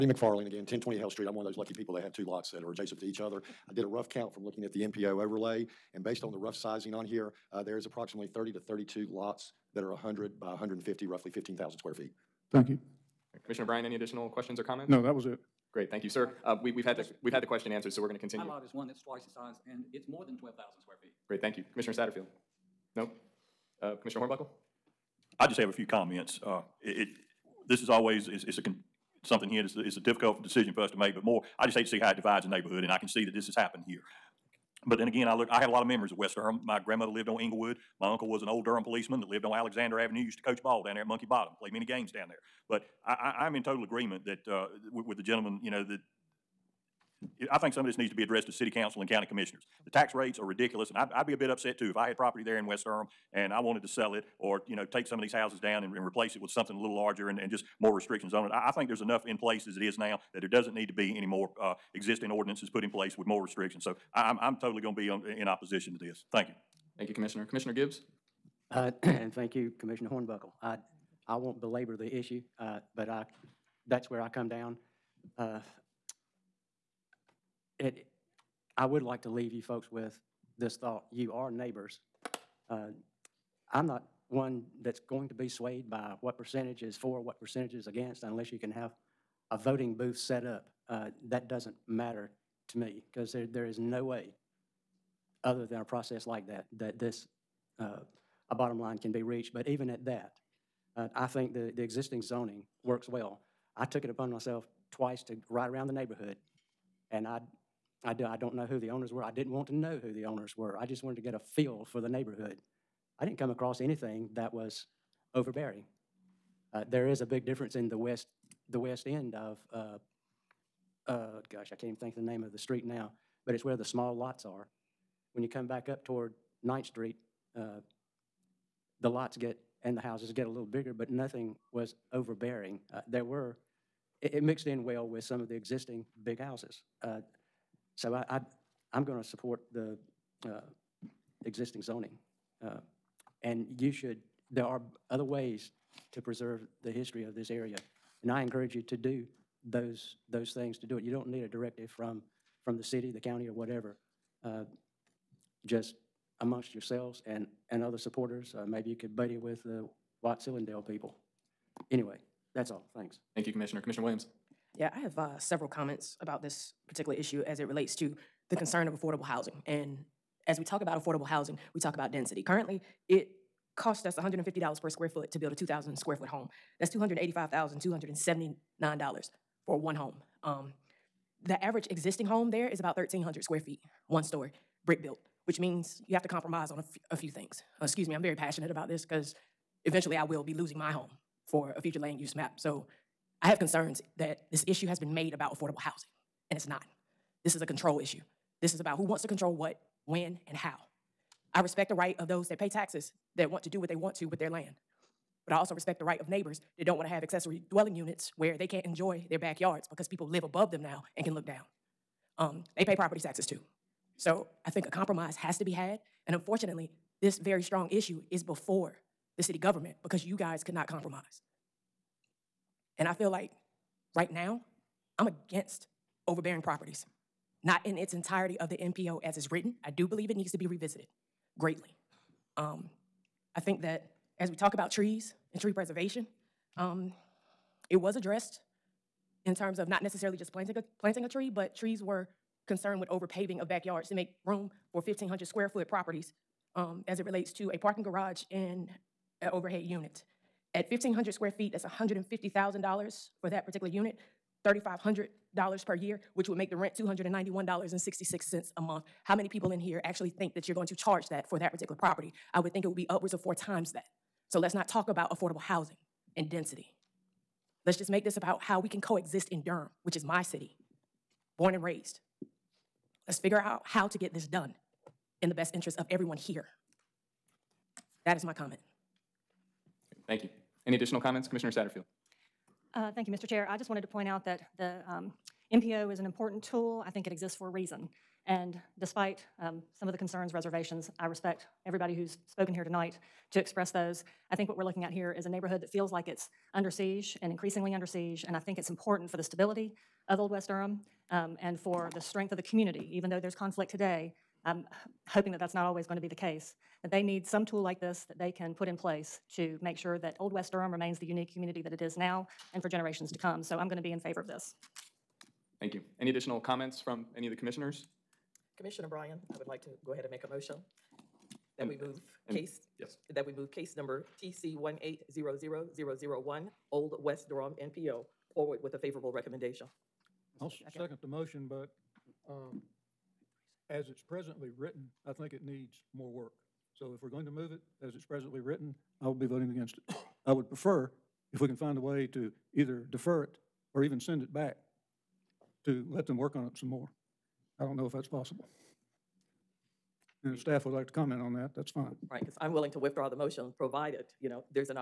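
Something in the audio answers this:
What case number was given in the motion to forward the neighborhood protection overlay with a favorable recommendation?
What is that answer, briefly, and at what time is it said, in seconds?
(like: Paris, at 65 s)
TC 1800001, at 324 s.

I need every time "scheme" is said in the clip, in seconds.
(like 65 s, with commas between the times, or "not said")
not said.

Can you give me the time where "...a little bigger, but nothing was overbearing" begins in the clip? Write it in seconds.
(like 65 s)
130 s.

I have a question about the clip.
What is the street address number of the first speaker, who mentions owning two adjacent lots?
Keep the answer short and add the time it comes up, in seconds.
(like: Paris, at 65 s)
1020, at 0 s.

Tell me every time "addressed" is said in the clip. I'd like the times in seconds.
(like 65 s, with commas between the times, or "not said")
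48 s, 238 s.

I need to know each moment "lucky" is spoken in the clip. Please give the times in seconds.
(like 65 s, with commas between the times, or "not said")
1 s.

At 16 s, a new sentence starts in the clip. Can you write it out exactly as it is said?
Uh, we, we've had the we've had the question answered, so we're going to continue.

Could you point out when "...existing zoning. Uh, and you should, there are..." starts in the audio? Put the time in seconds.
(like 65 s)
141 s.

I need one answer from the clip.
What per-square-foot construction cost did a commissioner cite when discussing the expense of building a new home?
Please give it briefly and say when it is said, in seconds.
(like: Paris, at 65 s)
$150, at 174 s.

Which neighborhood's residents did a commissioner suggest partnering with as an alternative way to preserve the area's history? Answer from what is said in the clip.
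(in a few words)
Watts-Hillandale.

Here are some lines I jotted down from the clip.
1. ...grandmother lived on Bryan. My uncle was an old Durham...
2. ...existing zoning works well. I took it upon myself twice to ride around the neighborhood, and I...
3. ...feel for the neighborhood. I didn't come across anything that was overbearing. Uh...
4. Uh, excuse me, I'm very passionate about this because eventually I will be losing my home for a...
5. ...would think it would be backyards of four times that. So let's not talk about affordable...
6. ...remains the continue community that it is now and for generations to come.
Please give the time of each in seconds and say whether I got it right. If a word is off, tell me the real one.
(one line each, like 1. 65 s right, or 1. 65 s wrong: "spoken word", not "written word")
1. 36 s wrong: "Englewood", not "Bryan"
2. 101 s right
3. 111 s right
4. 187 s right
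5. 262 s wrong: "upwards", not "backyards"
6. 310 s wrong: "unique", not "continue".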